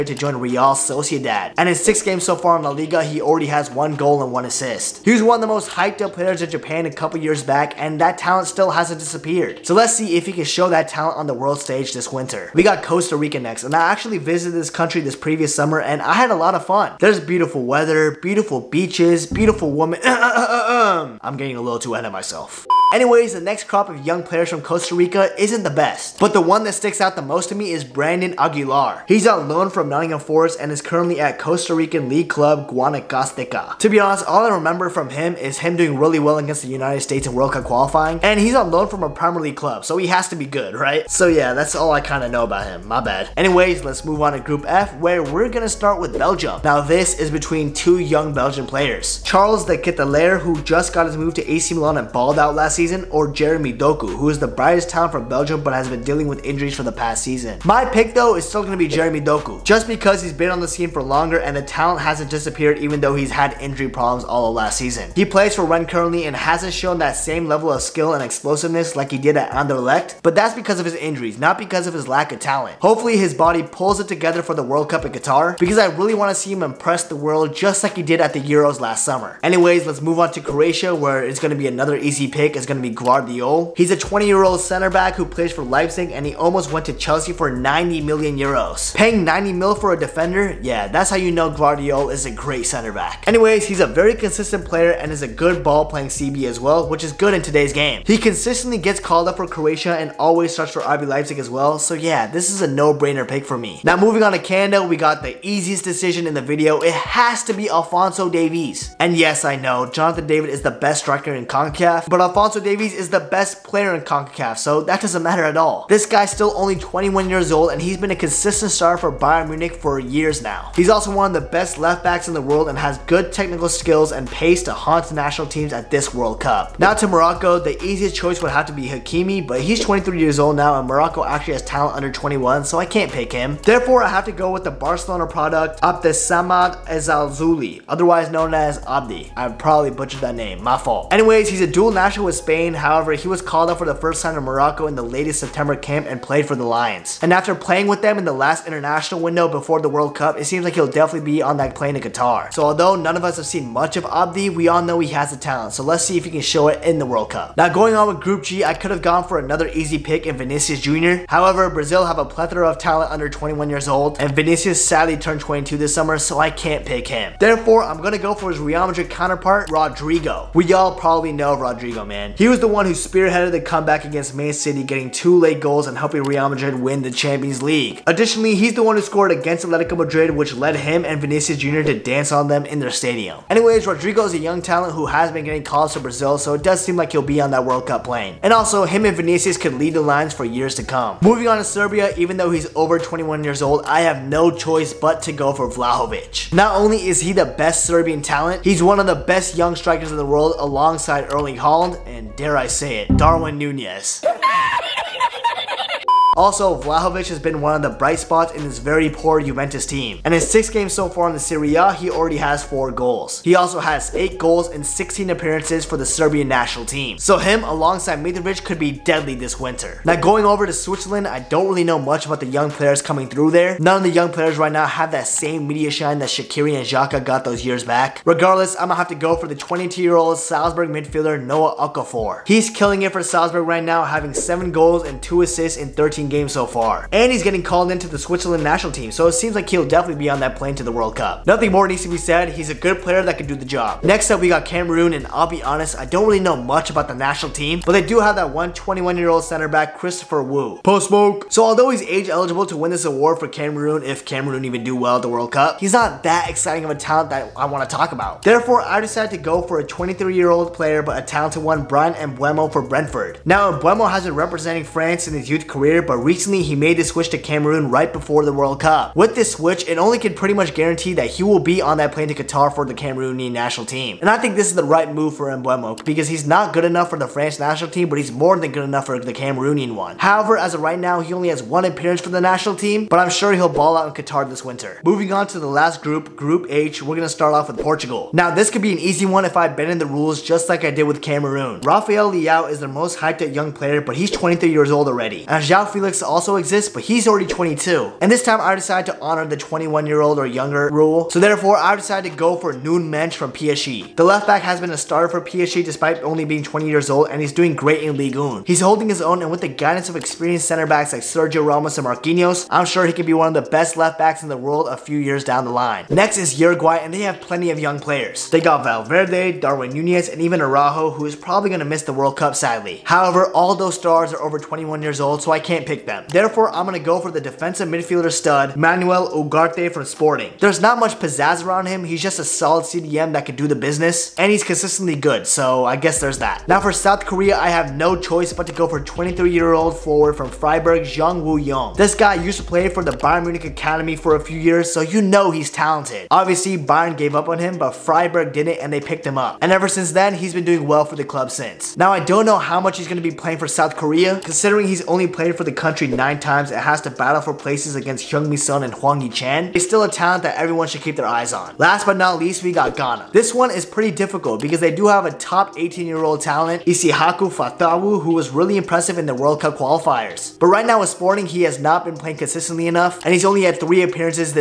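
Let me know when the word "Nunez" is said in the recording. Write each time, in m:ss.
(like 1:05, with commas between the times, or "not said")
3:23, 5:19.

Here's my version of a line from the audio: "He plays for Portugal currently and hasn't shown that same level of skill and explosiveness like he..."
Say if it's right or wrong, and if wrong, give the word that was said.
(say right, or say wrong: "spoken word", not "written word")
wrong: "Rennes", not "Portugal".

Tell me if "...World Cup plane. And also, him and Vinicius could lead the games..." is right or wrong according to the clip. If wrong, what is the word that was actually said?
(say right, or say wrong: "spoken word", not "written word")
wrong: "lines", not "games".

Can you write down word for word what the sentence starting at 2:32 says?
So although none of us have seen much of Abdi, we all know he has the talent.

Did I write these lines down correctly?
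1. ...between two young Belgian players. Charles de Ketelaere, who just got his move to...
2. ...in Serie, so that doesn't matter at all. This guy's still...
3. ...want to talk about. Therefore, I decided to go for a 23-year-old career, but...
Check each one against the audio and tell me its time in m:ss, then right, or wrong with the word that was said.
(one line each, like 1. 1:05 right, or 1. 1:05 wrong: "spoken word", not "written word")
1. 0:47 right
2. 1:53 wrong: "CONCACAF", not "Serie"
3. 4:17 wrong: "player", not "career".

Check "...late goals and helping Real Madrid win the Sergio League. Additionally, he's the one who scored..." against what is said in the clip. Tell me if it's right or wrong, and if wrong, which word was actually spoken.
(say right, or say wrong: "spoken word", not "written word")
wrong: "Champions", not "Sergio".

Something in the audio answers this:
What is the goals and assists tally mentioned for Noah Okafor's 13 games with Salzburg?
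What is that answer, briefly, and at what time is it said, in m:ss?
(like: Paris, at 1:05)
7 goals and 2 assists, at 3:54.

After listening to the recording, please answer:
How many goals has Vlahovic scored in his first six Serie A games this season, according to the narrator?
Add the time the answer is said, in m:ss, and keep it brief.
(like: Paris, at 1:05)
4, at 3:32.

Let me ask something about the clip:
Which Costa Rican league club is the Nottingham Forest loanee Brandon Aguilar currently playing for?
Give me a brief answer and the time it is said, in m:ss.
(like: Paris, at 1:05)
Guanacasteca, at 0:32.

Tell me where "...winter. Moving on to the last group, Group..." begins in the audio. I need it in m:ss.
4:44.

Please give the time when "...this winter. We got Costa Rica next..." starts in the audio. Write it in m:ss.
0:11.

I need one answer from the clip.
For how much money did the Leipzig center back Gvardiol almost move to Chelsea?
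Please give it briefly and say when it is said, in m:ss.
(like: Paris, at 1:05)
90 million euros, at 1:27.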